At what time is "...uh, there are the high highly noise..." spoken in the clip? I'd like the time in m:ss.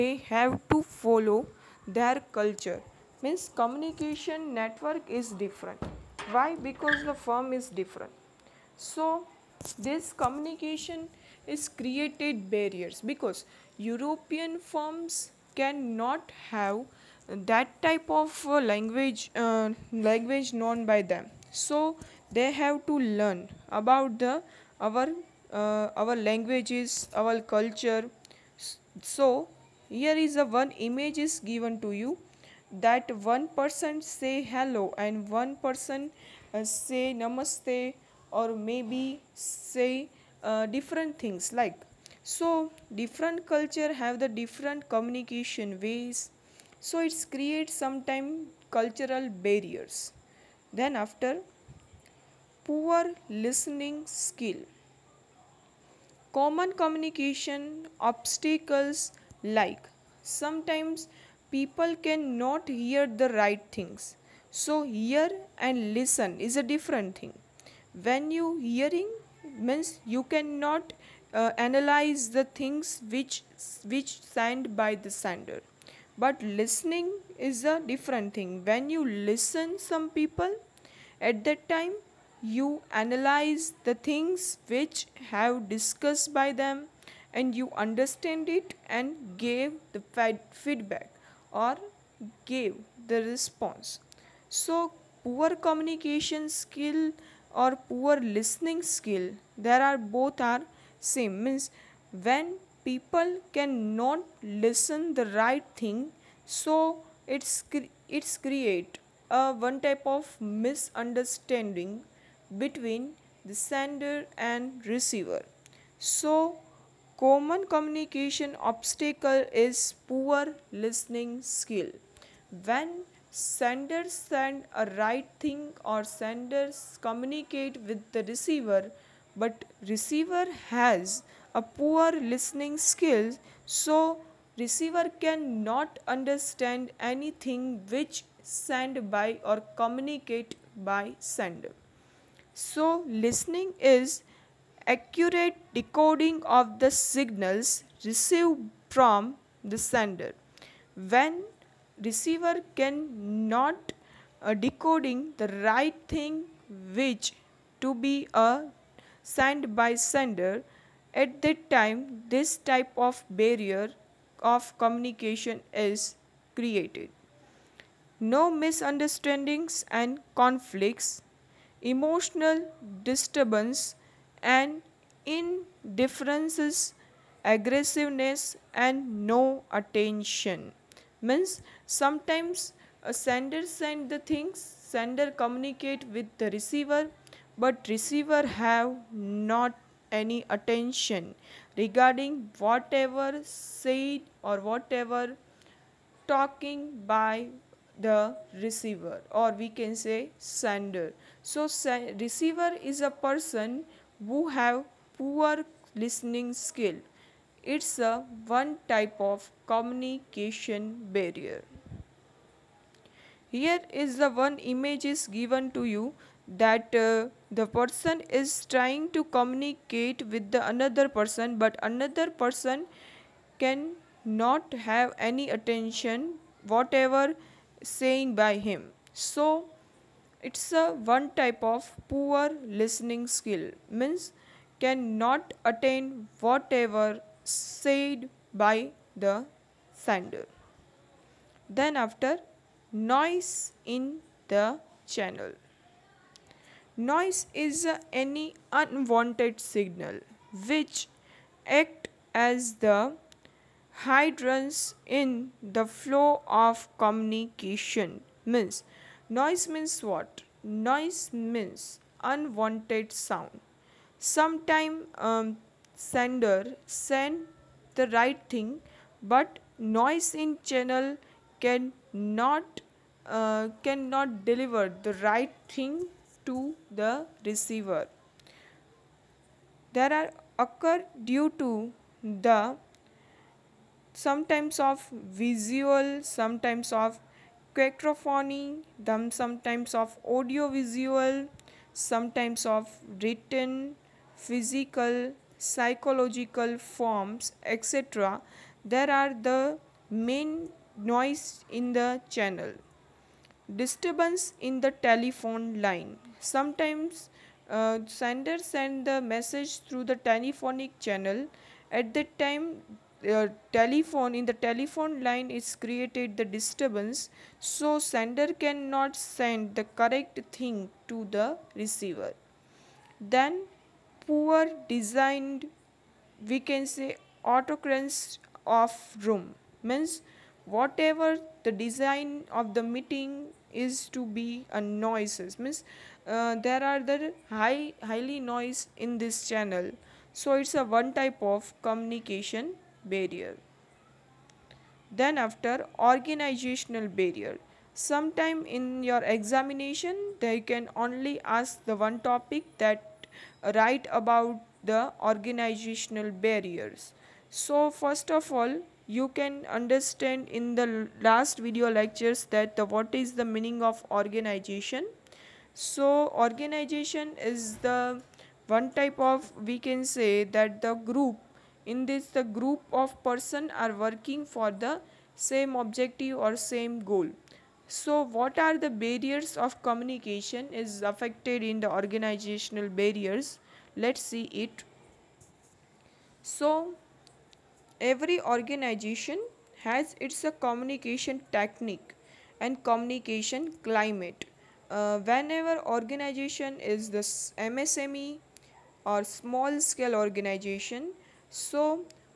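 5:36.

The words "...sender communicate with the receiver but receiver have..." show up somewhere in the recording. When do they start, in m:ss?
3:04.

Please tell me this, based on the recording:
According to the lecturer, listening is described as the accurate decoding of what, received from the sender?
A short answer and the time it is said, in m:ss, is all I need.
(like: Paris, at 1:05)
signals, at 2:26.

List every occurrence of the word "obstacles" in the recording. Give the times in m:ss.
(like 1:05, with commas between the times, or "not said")
0:57, 1:58.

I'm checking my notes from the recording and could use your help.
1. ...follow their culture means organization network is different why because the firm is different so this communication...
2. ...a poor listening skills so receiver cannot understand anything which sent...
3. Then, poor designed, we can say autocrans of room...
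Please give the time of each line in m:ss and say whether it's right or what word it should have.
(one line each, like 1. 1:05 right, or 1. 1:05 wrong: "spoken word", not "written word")
1. 0:00 wrong: "communication", not "organization"
2. 2:11 right
3. 5:23 right.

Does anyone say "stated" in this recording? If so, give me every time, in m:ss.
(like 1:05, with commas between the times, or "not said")
not said.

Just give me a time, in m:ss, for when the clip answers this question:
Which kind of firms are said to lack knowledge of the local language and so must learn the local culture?
0:13.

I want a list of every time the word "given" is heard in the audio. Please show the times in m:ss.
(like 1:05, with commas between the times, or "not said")
0:31, 3:35.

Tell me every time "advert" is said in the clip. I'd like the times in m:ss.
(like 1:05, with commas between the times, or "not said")
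not said.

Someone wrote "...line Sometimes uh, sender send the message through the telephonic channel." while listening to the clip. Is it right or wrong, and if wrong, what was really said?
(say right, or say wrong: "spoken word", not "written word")
right.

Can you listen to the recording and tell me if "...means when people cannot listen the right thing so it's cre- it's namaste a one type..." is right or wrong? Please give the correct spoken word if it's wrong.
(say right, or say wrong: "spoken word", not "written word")
wrong: "create", not "namaste".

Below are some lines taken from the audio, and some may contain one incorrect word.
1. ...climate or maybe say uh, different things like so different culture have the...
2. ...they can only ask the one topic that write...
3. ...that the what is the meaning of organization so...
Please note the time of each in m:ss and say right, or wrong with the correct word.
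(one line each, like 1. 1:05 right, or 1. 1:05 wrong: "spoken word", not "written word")
1. 0:37 wrong: "namaste", not "climate"
2. 5:50 right
3. 6:02 right.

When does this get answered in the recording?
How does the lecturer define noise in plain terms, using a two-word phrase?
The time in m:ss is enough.
4:22.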